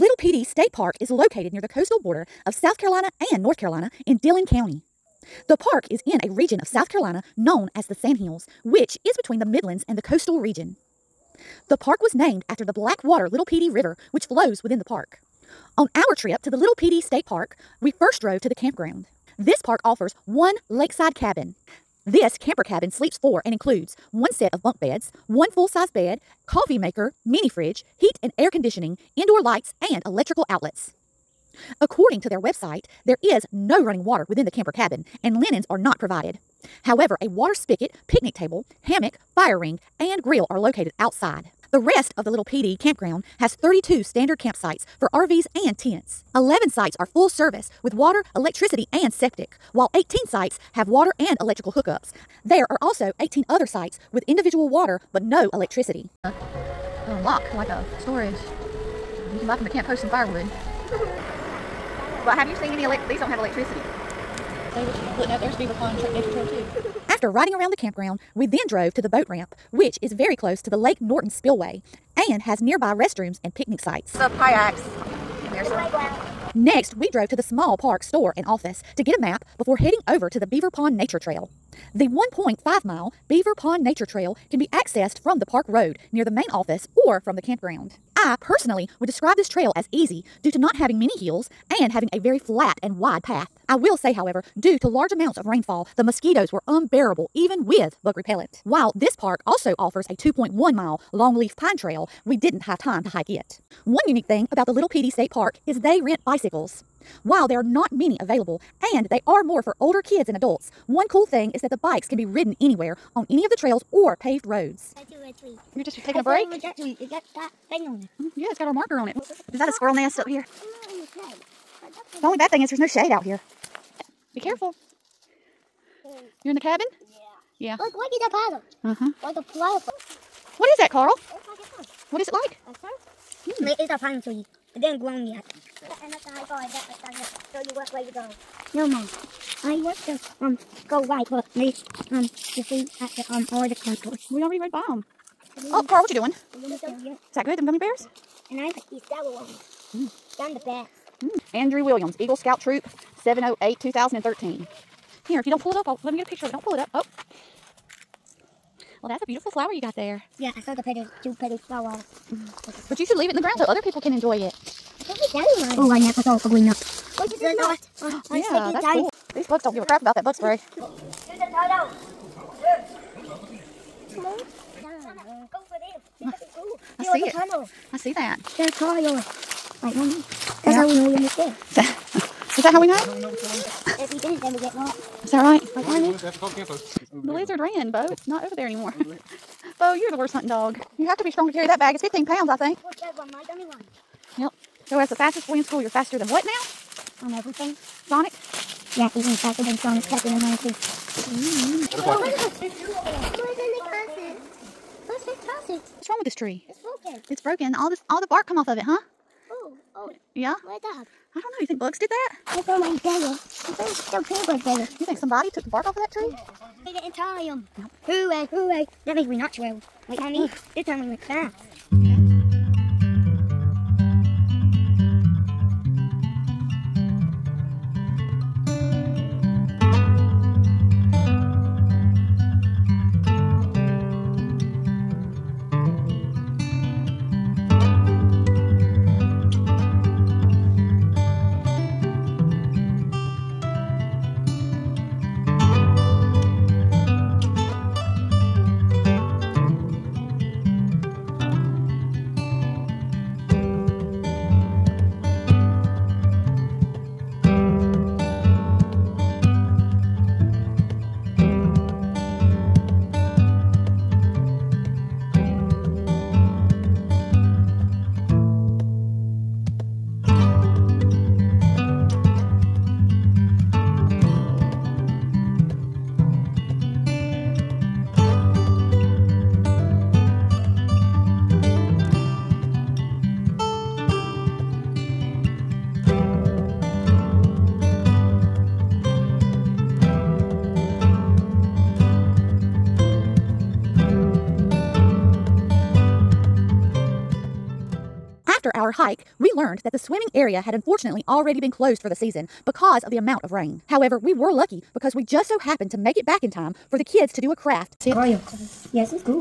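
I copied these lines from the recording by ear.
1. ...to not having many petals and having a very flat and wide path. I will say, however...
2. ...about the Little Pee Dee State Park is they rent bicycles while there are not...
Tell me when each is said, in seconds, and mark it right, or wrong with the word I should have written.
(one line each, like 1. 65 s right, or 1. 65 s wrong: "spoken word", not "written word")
1. 90 s wrong: "hills", not "petals"
2. 104 s right.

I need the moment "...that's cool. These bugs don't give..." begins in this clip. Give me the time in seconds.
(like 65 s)
168 s.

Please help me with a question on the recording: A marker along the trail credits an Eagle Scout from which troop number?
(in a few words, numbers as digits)
Troop 708.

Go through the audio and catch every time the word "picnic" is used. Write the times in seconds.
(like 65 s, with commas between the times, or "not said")
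38 s, 73 s.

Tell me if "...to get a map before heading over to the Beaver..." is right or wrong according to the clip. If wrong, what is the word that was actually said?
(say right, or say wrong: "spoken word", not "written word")
right.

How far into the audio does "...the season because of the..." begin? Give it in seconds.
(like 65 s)
302 s.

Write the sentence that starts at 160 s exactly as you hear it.
Yeah, I saw the petals, two petals flower.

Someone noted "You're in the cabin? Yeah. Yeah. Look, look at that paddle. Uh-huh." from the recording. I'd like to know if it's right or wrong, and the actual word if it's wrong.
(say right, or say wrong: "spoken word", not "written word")
right.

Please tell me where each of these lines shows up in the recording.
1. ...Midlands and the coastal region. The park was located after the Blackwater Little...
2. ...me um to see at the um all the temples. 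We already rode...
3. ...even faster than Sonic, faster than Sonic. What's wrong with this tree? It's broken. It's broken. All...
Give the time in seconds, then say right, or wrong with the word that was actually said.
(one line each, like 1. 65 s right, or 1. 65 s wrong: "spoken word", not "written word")
1. 9 s wrong: "named", not "located"
2. 141 s right
3. 199 s right.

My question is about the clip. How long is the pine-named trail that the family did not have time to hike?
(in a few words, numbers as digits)
2.1 miles.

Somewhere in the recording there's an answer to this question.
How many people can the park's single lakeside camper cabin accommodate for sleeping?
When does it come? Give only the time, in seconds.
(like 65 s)
22 s.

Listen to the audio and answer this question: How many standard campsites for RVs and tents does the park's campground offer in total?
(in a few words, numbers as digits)
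32.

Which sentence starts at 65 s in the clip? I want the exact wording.
There's Beaver Pond Nature Trail too.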